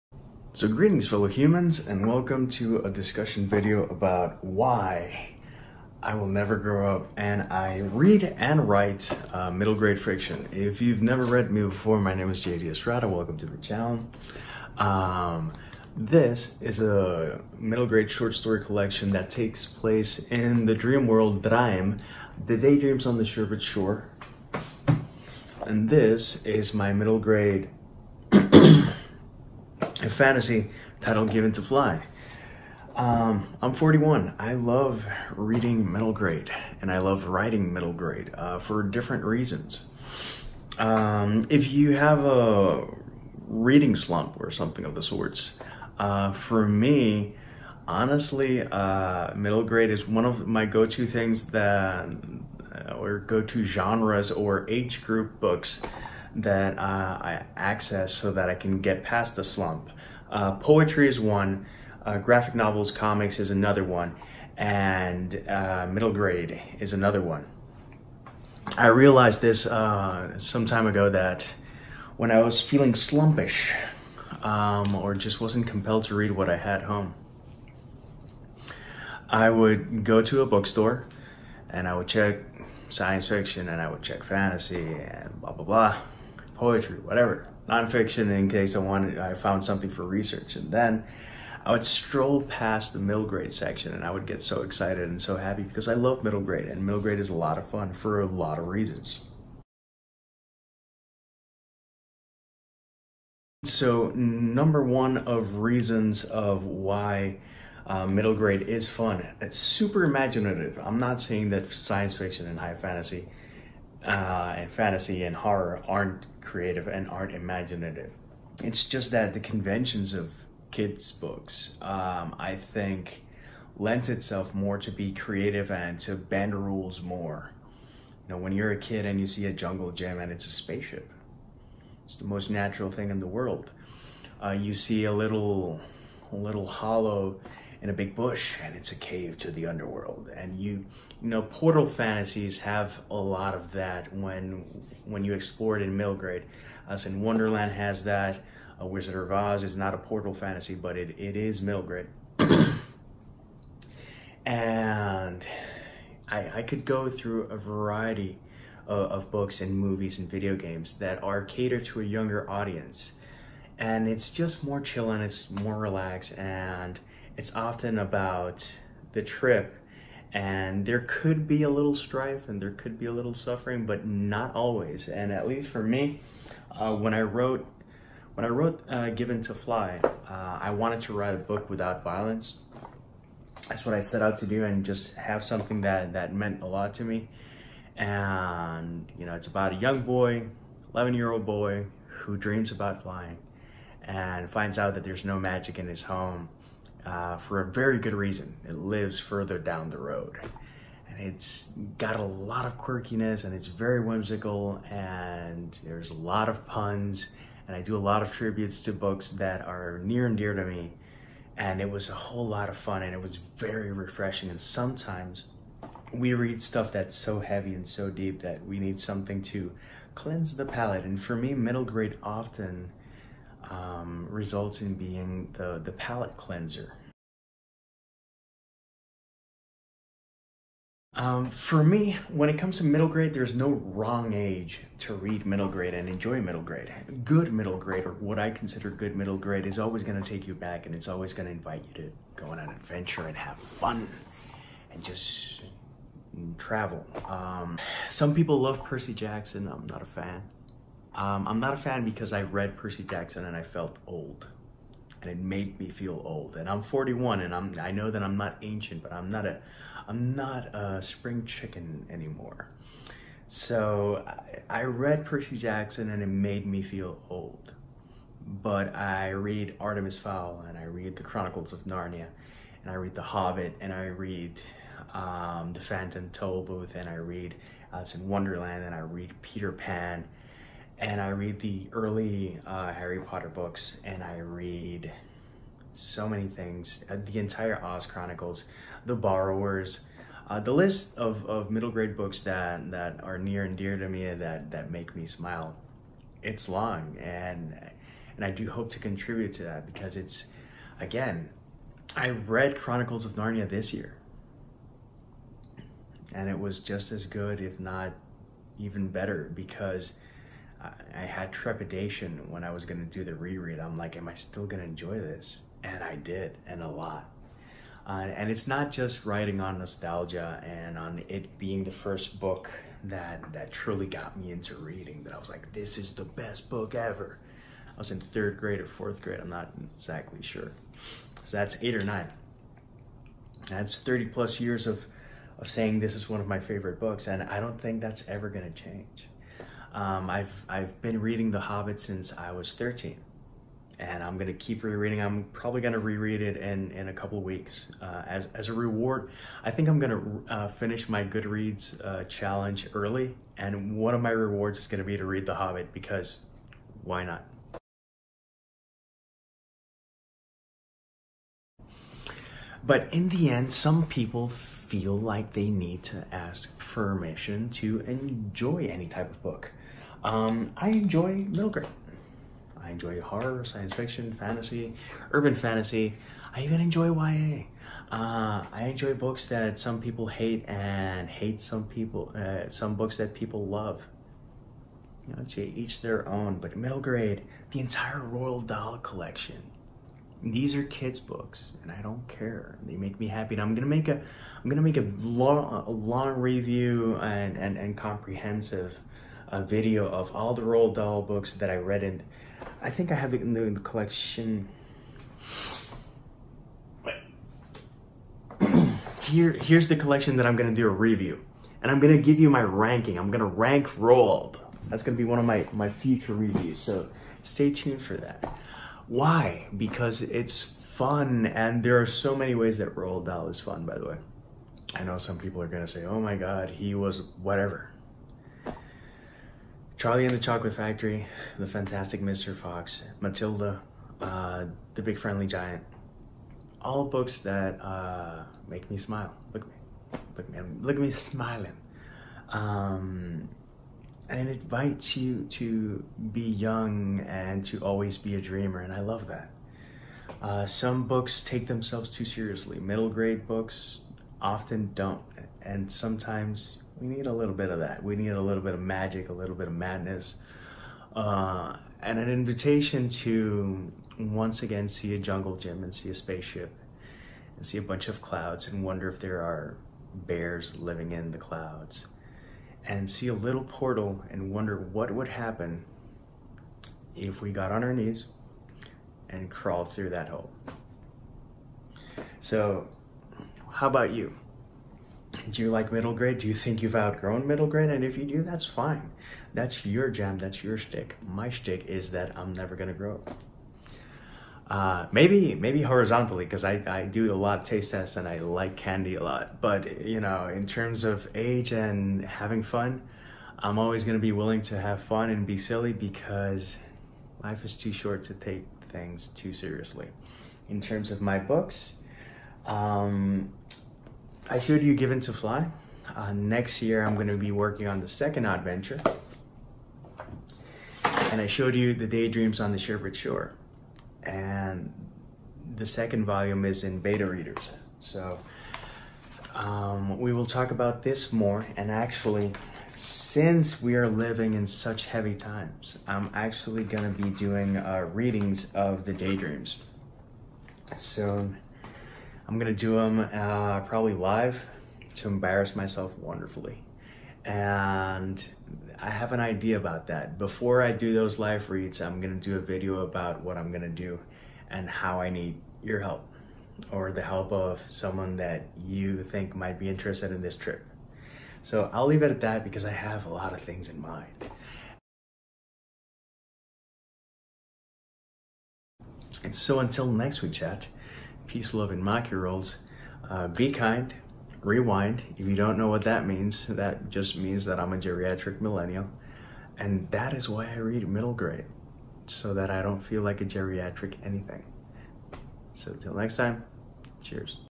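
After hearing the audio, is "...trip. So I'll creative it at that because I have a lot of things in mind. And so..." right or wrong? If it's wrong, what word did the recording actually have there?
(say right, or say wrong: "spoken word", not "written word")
wrong: "leave", not "creative".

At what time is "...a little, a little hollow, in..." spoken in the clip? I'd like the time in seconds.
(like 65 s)
135 s.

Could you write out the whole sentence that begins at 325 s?
That I was like, this is the best book ever.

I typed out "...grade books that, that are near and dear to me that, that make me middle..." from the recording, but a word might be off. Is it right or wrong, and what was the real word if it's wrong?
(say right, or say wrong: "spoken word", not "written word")
wrong: "smile", not "middle".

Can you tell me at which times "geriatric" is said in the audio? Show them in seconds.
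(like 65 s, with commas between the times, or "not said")
577 s, 583 s.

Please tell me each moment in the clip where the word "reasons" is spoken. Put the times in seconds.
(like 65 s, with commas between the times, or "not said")
39 s, 98 s, 105 s, 198 s.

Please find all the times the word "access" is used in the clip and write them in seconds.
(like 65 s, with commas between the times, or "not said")
57 s.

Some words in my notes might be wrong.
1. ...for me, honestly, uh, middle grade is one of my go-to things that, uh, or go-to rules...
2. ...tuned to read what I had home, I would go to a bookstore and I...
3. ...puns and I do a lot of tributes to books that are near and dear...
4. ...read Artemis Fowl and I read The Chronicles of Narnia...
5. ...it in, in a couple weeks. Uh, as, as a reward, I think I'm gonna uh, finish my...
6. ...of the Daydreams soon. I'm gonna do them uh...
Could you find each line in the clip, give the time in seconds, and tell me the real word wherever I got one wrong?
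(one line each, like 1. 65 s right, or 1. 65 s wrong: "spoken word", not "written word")
1. 46 s wrong: "genres", not "rules"
2. 75 s wrong: "compelled", not "tuned"
3. 206 s right
4. 269 s right
5. 346 s right
6. 538 s right.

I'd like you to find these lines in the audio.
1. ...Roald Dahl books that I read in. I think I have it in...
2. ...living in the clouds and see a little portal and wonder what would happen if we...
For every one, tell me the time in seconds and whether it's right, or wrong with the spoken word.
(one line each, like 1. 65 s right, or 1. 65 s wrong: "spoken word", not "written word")
1. 400 s right
2. 470 s right.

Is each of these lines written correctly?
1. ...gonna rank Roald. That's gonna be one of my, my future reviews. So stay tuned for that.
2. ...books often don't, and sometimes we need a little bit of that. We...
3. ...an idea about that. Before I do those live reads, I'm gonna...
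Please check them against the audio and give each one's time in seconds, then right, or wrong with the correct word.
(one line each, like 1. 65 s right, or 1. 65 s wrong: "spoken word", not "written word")
1. 413 s right
2. 453 s right
3. 549 s right.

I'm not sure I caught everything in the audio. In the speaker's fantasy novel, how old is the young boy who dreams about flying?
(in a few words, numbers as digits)
11.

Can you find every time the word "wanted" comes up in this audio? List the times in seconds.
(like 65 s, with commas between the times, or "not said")
88 s, 180 s.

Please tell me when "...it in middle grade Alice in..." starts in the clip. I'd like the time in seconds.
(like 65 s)
145 s.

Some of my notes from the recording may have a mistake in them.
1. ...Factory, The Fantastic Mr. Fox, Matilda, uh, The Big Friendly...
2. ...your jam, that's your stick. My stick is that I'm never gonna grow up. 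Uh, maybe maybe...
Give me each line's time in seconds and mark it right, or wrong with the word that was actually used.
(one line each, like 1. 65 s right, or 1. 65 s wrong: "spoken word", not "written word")
1. 430 s right
2. 489 s right.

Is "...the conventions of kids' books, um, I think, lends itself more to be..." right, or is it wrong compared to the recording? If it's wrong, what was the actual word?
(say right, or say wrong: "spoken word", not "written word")
right.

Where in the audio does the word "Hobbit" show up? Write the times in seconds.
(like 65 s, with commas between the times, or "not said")
273 s, 341 s, 355 s.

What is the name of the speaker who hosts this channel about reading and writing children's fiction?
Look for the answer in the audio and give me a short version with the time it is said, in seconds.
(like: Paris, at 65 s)
JD Estrada, at 12 s.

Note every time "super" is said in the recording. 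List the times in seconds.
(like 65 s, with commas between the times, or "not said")
109 s.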